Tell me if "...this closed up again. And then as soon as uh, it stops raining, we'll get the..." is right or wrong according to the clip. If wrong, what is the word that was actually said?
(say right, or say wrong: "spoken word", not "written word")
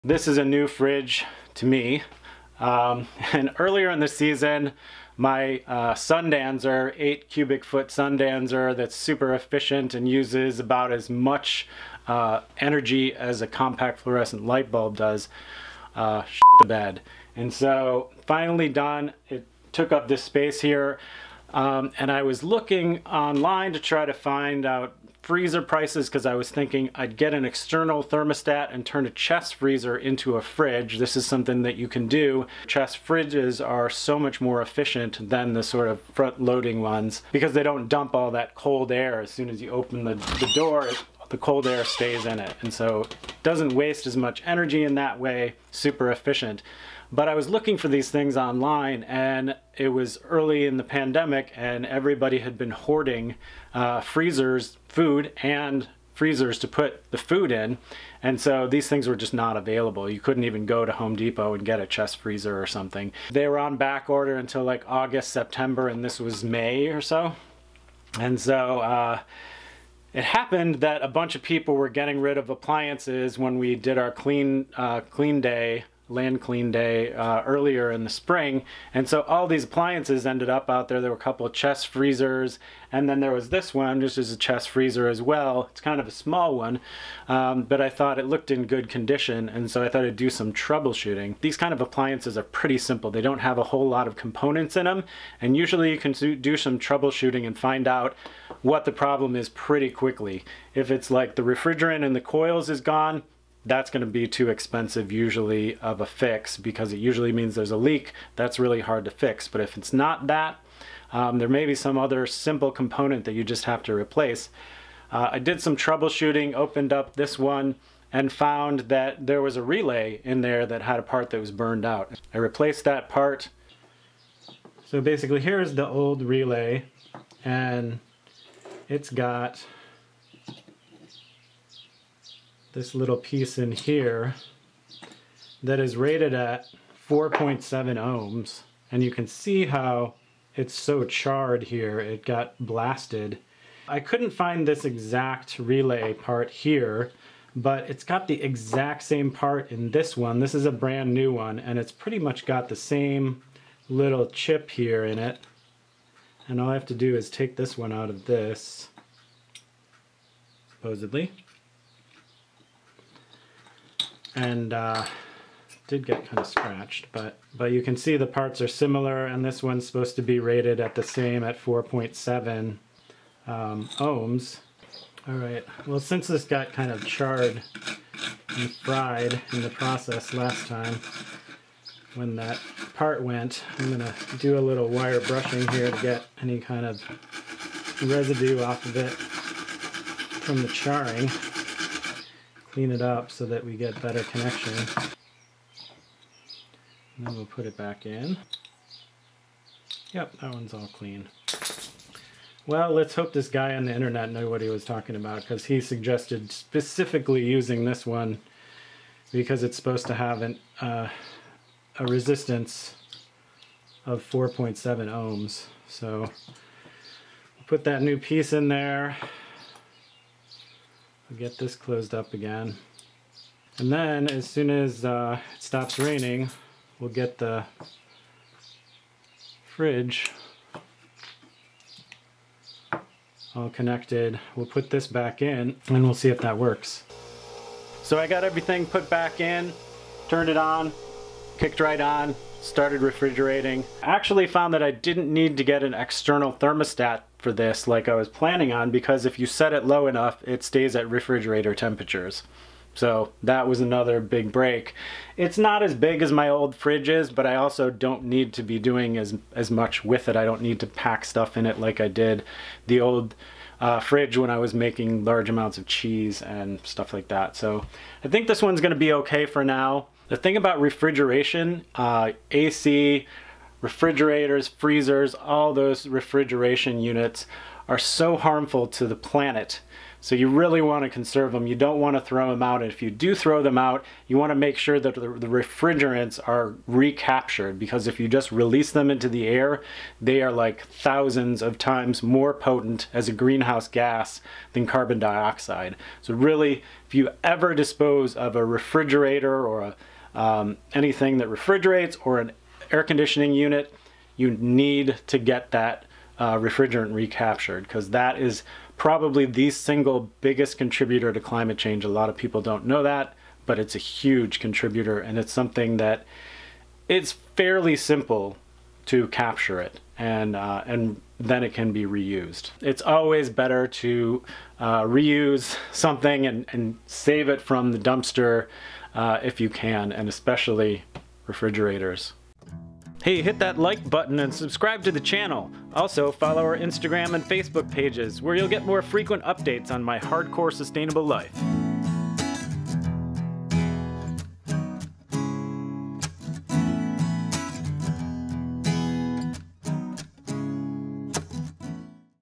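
right.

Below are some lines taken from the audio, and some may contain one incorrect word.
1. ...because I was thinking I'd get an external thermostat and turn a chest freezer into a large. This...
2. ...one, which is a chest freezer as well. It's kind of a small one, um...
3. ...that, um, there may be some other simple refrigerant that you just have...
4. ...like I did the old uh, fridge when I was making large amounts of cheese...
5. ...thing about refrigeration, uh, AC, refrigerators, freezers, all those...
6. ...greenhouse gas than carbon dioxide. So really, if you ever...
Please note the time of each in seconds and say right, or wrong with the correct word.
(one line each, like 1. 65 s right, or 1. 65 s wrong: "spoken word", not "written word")
1. 26 s wrong: "fridge", not "large"
2. 83 s right
3. 110 s wrong: "component", not "refrigerant"
4. 261 s right
5. 270 s right
6. 293 s right.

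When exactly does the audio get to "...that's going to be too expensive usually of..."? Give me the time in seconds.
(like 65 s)
103 s.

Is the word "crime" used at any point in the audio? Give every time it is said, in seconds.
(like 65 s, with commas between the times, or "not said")
not said.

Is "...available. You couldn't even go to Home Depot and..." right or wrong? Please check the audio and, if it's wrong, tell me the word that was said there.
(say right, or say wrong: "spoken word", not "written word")
right.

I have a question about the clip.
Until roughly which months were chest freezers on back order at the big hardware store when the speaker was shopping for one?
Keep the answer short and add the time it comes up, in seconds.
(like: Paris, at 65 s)
August, September, at 64 s.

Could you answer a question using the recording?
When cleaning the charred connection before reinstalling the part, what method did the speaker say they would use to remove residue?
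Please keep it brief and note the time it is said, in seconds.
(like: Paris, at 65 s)
wire brushing, at 184 s.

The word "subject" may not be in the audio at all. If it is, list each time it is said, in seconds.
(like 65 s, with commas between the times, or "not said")
not said.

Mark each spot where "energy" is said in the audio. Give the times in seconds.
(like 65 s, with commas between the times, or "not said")
12 s, 44 s.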